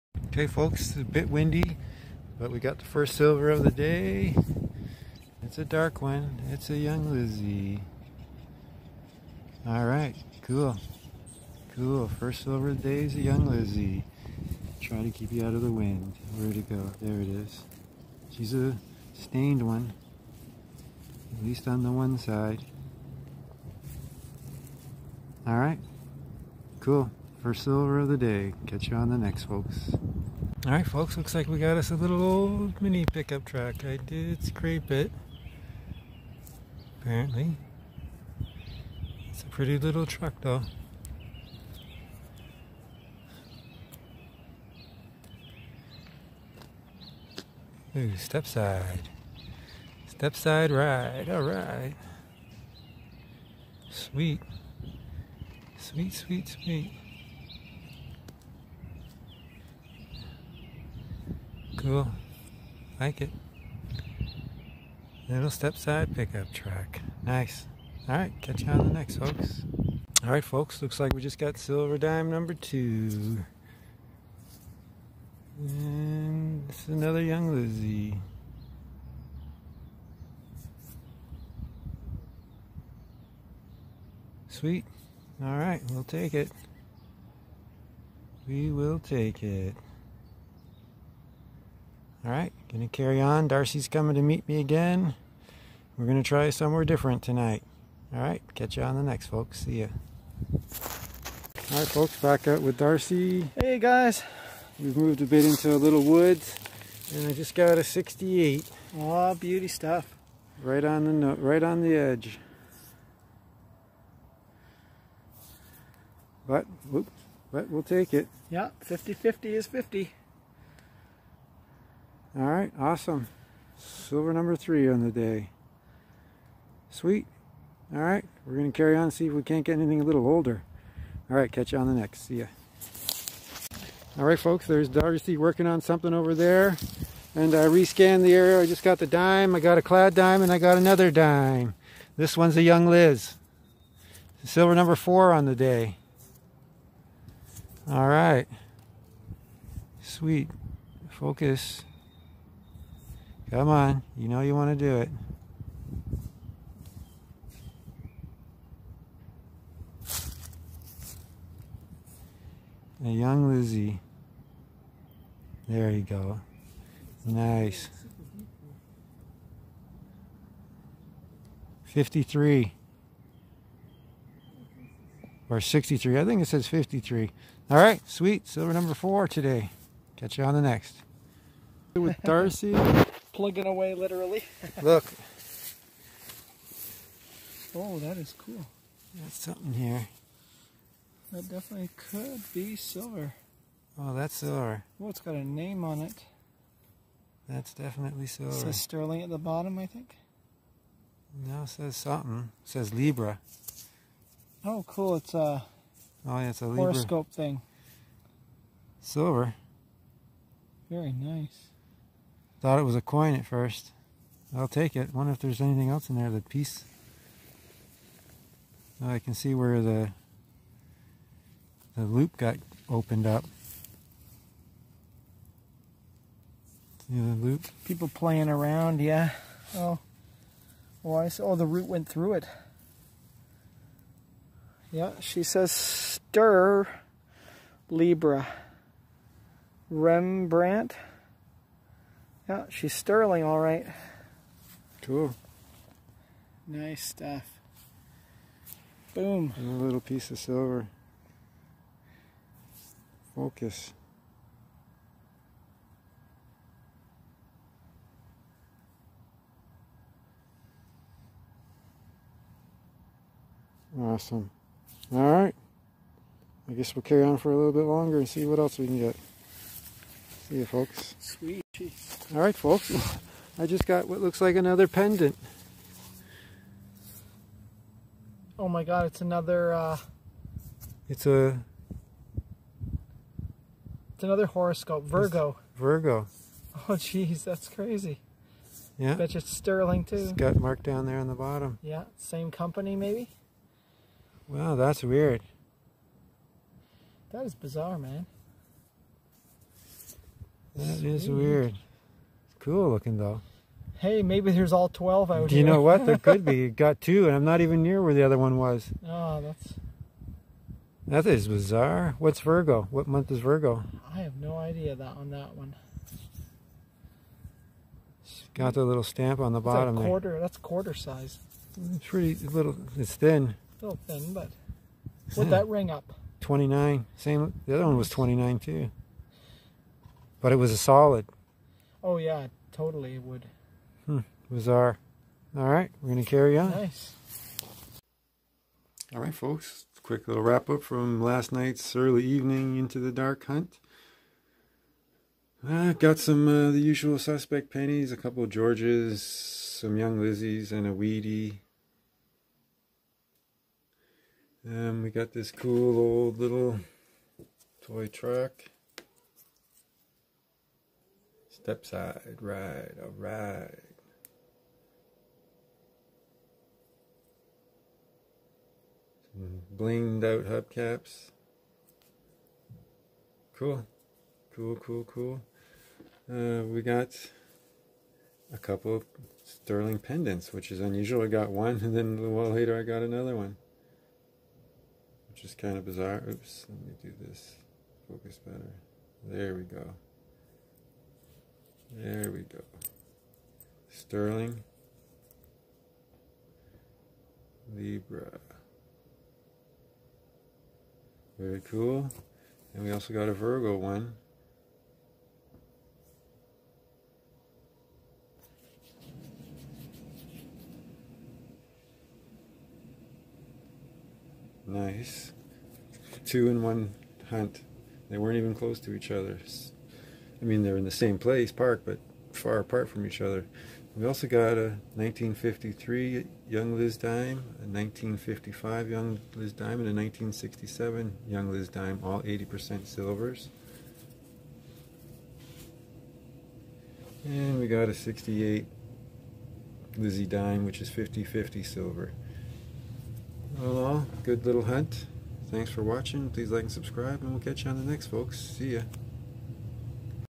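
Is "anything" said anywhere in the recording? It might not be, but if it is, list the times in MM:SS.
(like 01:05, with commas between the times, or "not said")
02:09, 03:35.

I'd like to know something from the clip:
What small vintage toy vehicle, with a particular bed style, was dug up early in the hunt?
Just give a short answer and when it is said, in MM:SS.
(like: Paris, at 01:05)
Step side pickup truck, at 01:05.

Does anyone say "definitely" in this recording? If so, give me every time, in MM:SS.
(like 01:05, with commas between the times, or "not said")
03:11, 03:17.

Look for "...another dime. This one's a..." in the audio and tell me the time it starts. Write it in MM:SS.
02:20.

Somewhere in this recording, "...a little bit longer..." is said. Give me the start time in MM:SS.
04:27.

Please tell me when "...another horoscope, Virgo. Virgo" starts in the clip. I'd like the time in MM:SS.
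04:44.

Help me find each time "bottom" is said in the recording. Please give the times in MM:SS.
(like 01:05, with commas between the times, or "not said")
03:19, 04:51, 05:19.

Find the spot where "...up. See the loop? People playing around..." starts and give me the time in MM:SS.
03:43.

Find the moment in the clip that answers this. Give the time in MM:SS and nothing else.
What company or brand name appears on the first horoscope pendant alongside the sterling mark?
03:59.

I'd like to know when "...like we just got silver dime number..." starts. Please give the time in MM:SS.
01:11.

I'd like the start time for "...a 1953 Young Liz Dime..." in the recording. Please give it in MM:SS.
07:04.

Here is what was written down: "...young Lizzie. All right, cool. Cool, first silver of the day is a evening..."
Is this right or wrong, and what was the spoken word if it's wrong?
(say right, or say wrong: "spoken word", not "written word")
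wrong: "young", not "evening".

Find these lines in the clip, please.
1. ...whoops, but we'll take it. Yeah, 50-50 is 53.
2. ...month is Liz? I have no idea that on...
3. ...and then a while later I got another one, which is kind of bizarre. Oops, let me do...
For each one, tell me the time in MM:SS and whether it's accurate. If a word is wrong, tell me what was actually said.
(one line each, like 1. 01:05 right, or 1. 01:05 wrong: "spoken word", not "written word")
1. 01:56 wrong: "50", not "53"
2. 05:13 wrong: "Virgo", not "Liz"
3. 06:21 right.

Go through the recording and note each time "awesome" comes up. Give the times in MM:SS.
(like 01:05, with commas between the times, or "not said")
02:02, 04:23.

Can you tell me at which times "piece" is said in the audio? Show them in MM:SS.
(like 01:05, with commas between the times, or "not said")
03:36, 04:10.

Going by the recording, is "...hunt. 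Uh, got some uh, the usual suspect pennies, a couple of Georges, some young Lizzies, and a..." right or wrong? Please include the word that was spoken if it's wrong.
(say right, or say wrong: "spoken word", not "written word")
right.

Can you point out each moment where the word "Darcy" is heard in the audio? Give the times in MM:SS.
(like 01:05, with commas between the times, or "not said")
01:33, 01:42, 02:14, 03:02.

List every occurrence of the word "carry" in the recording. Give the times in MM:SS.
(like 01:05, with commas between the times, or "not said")
01:32, 02:08, 04:27, 05:36.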